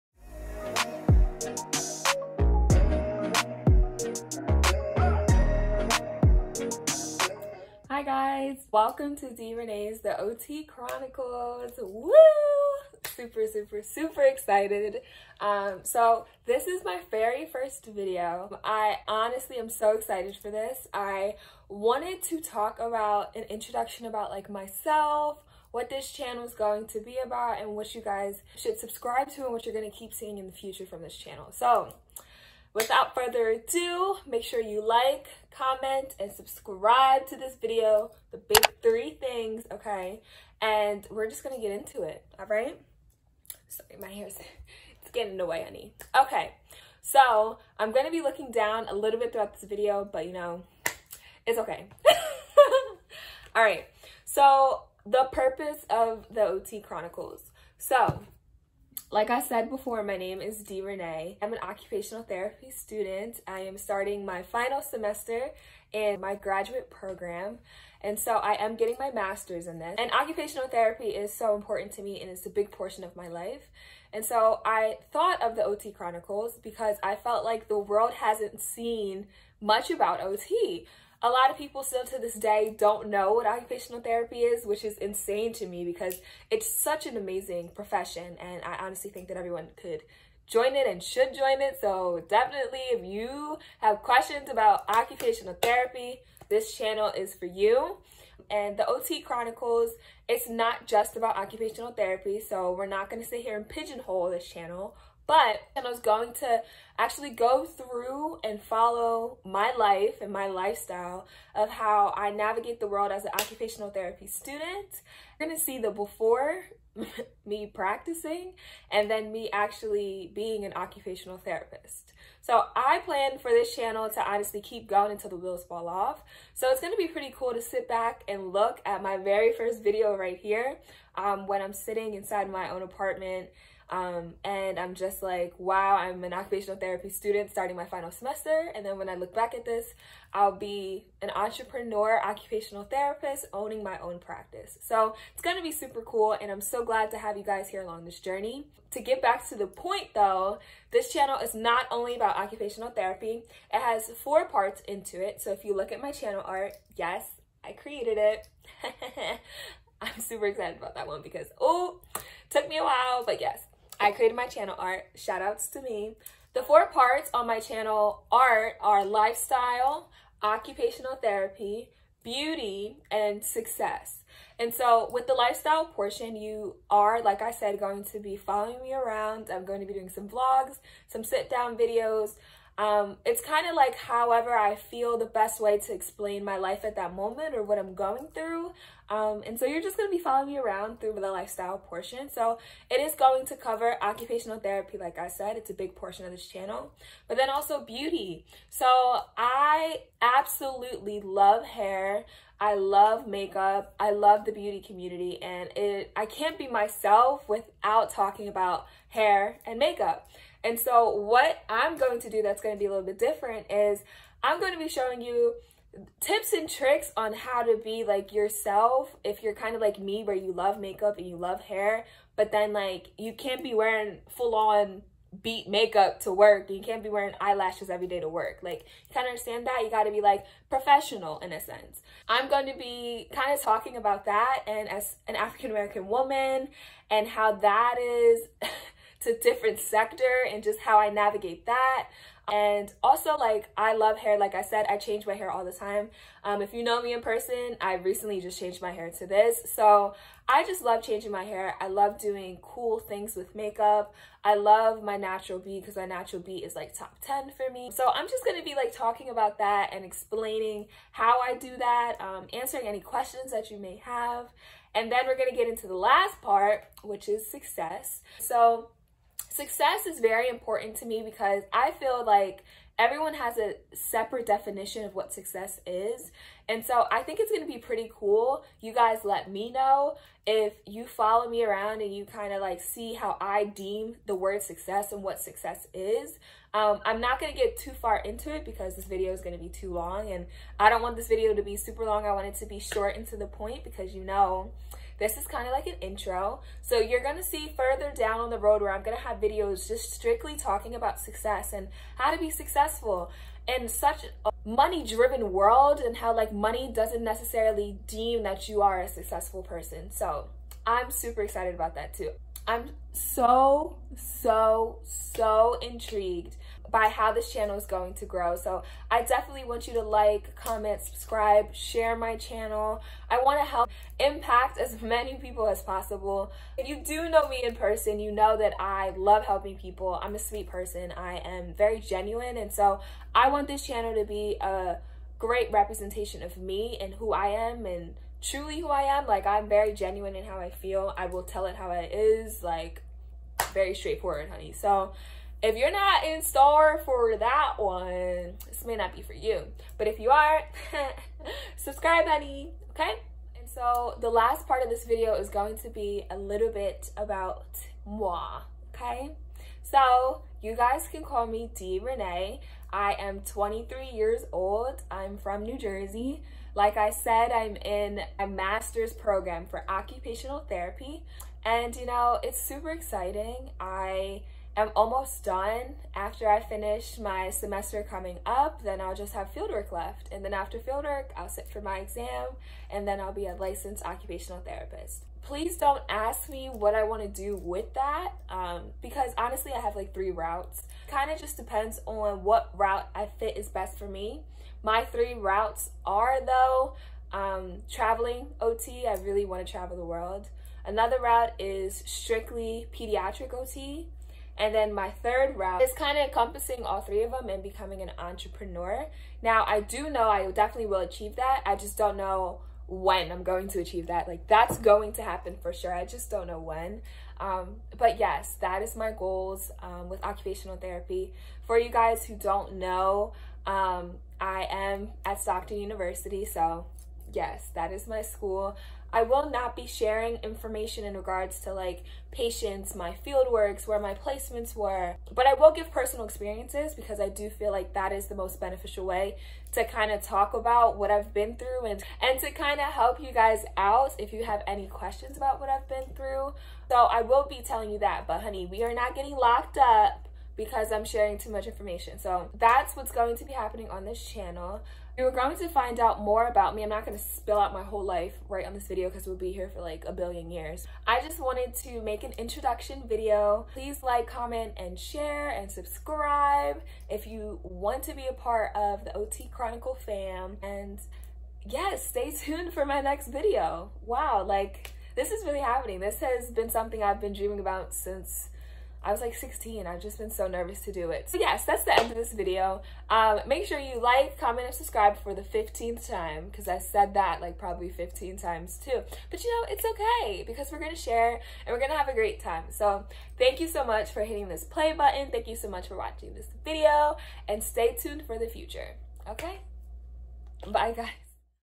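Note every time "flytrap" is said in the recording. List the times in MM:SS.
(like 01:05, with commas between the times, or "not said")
not said.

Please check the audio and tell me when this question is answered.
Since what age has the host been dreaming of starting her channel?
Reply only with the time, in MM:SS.
07:59.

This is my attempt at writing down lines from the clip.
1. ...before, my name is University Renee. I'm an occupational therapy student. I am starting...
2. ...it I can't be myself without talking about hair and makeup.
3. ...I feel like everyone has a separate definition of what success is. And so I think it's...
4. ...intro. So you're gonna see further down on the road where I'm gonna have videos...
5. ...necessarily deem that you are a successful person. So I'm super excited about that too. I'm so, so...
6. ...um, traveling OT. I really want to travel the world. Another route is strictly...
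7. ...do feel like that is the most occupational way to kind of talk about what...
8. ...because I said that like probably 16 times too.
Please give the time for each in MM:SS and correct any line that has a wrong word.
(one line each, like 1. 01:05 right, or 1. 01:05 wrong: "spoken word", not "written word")
1. 00:59 wrong: "Dee", not "University"
2. 03:25 right
3. 04:31 right
4. 04:56 right
5. 05:07 right
6. 06:37 right
7. 07:17 wrong: "beneficial", not "occupational"
8. 08:06 wrong: "15", not "16".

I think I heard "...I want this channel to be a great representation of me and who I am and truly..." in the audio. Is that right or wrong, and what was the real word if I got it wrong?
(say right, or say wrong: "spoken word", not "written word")
right.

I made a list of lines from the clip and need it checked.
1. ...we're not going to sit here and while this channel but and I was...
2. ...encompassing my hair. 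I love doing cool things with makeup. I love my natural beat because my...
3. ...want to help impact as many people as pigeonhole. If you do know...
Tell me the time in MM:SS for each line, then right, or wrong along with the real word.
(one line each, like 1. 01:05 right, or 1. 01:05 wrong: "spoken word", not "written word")
1. 01:42 wrong: "pigeonhole", not "while"
2. 04:11 wrong: "changing", not "encompassing"
3. 05:23 wrong: "possible", not "pigeonhole".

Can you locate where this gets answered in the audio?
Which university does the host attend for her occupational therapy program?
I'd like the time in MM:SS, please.
07:05.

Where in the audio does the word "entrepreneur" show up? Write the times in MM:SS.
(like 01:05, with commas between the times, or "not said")
02:21, 06:48.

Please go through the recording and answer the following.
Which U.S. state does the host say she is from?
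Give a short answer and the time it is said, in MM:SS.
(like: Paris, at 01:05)
New Jersey, at 06:05.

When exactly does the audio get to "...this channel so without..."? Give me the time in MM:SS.
00:31.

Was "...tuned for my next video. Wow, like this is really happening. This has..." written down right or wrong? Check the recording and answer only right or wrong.
right.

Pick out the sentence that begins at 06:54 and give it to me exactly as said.
Like that's going to happen for sure.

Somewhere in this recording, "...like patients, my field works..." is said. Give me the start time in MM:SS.
07:11.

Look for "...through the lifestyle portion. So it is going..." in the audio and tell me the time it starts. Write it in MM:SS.
03:10.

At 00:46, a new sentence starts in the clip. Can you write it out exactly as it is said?
Okay, so I'm gonna be looking down a little bit throughout this video, but you know, it's okay.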